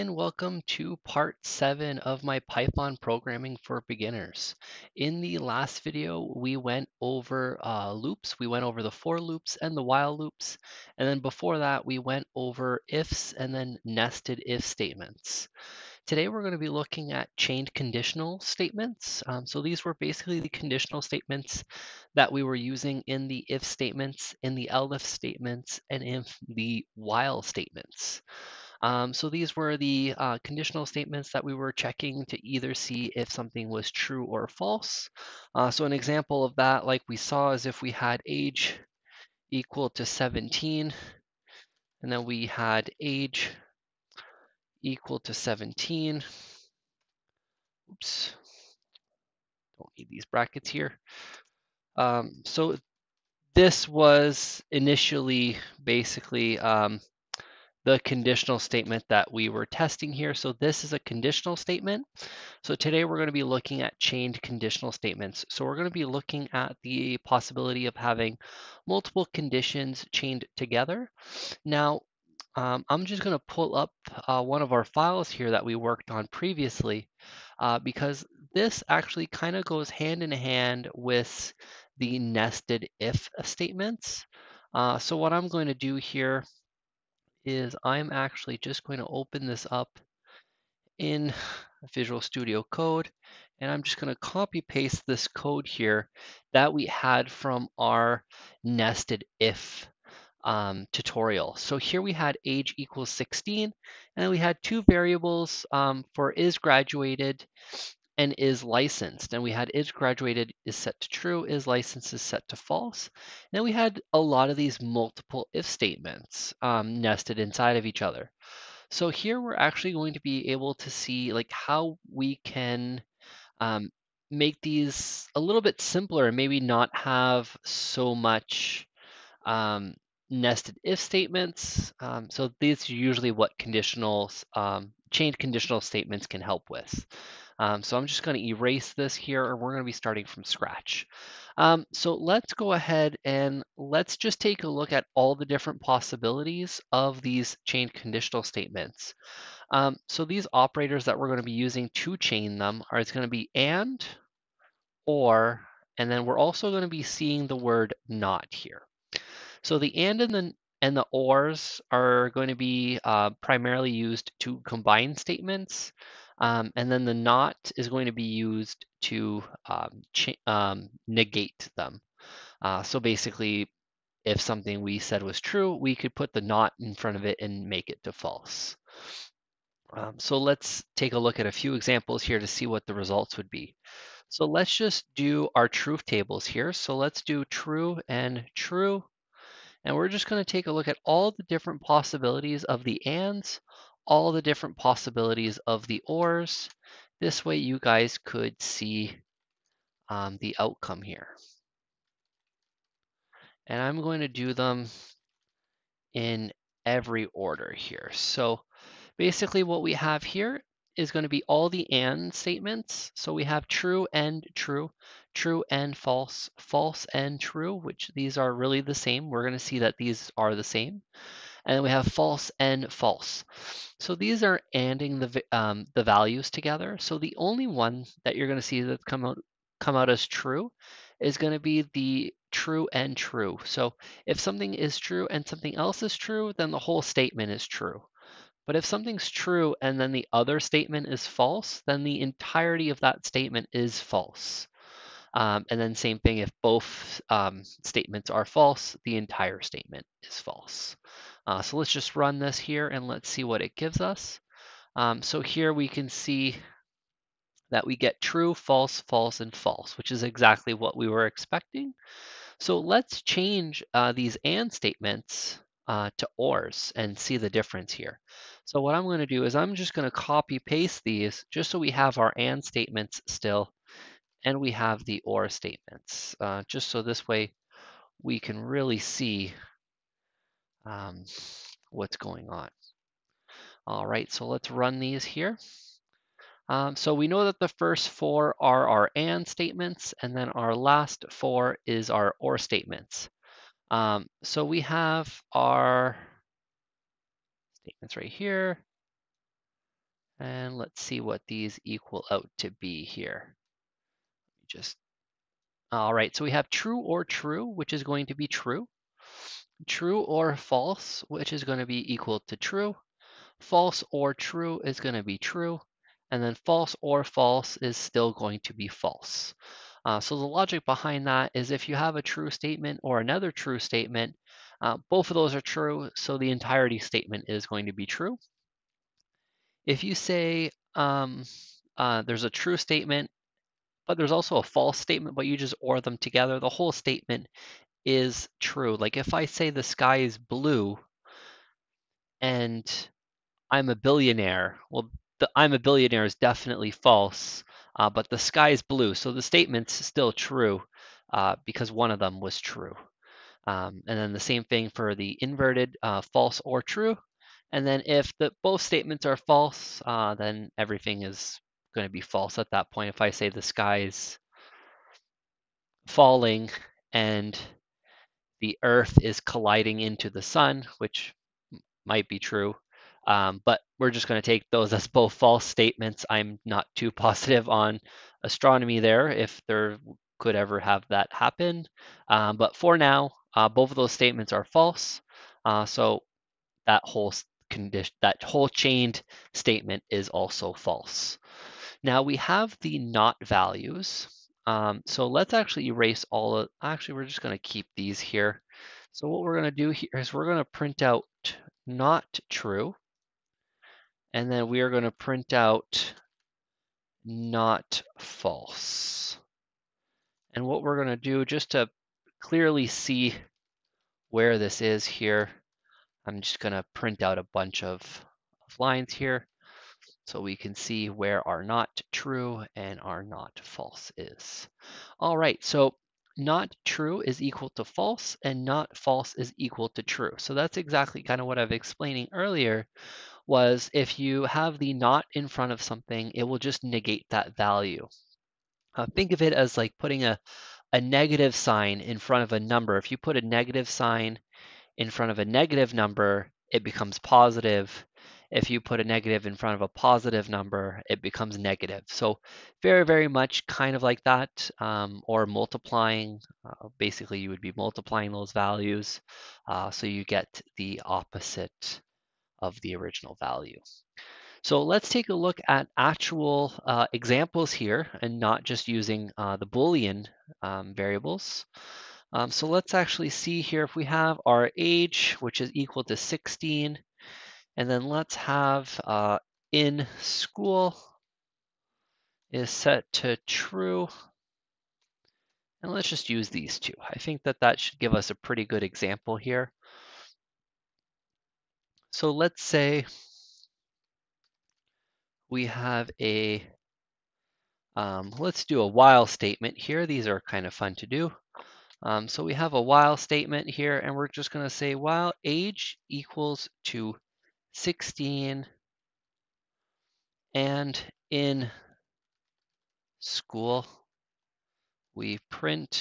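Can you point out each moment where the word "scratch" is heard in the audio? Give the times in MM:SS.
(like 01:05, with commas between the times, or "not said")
02:20.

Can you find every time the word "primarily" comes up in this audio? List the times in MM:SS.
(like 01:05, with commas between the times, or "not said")
02:43.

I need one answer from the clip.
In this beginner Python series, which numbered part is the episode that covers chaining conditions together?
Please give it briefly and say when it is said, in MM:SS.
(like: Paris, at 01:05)
Part seven, at 00:01.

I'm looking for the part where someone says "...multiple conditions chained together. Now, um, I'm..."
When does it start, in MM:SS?
01:08.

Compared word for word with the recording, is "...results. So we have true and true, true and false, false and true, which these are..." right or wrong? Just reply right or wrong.
wrong.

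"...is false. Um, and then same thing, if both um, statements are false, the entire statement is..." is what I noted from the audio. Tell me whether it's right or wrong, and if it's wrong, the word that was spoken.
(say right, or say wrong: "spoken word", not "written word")
right.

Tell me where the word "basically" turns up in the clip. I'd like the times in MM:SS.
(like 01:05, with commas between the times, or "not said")
00:19, 00:55, 02:52, 03:29, 07:36.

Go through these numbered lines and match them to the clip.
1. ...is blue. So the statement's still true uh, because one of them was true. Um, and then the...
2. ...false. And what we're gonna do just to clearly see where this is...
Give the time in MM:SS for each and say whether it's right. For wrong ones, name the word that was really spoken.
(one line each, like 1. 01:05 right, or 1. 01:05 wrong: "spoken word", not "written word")
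1. 05:48 right
2. 06:48 right.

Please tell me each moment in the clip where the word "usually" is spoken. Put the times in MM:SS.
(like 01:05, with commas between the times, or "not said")
02:12.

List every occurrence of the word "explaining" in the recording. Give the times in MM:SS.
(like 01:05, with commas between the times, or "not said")
07:11.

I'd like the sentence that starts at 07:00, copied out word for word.
So we can see where are not true and are not false is.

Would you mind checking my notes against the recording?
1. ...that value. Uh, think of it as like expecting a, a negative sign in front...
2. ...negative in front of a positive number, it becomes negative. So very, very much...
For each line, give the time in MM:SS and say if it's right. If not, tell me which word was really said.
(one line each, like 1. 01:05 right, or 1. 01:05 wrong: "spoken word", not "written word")
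1. 07:17 wrong: "putting", not "expecting"
2. 07:29 right.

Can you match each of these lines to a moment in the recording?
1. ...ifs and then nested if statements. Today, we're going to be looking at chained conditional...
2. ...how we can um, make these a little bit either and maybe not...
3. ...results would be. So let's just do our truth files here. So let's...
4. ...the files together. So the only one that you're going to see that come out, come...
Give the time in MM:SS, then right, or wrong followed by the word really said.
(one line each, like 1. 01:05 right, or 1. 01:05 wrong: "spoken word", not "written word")
1. 00:12 right
2. 02:01 wrong: "simpler", not "either"
3. 03:02 wrong: "tables", not "files"
4. 03:45 wrong: "values", not "files".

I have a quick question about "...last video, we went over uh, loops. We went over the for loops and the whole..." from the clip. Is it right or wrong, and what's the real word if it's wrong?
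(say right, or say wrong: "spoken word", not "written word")
wrong: "while", not "whole".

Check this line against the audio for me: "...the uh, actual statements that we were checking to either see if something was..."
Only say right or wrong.
wrong.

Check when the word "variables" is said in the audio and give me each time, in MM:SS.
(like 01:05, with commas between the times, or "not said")
01:44, 07:50.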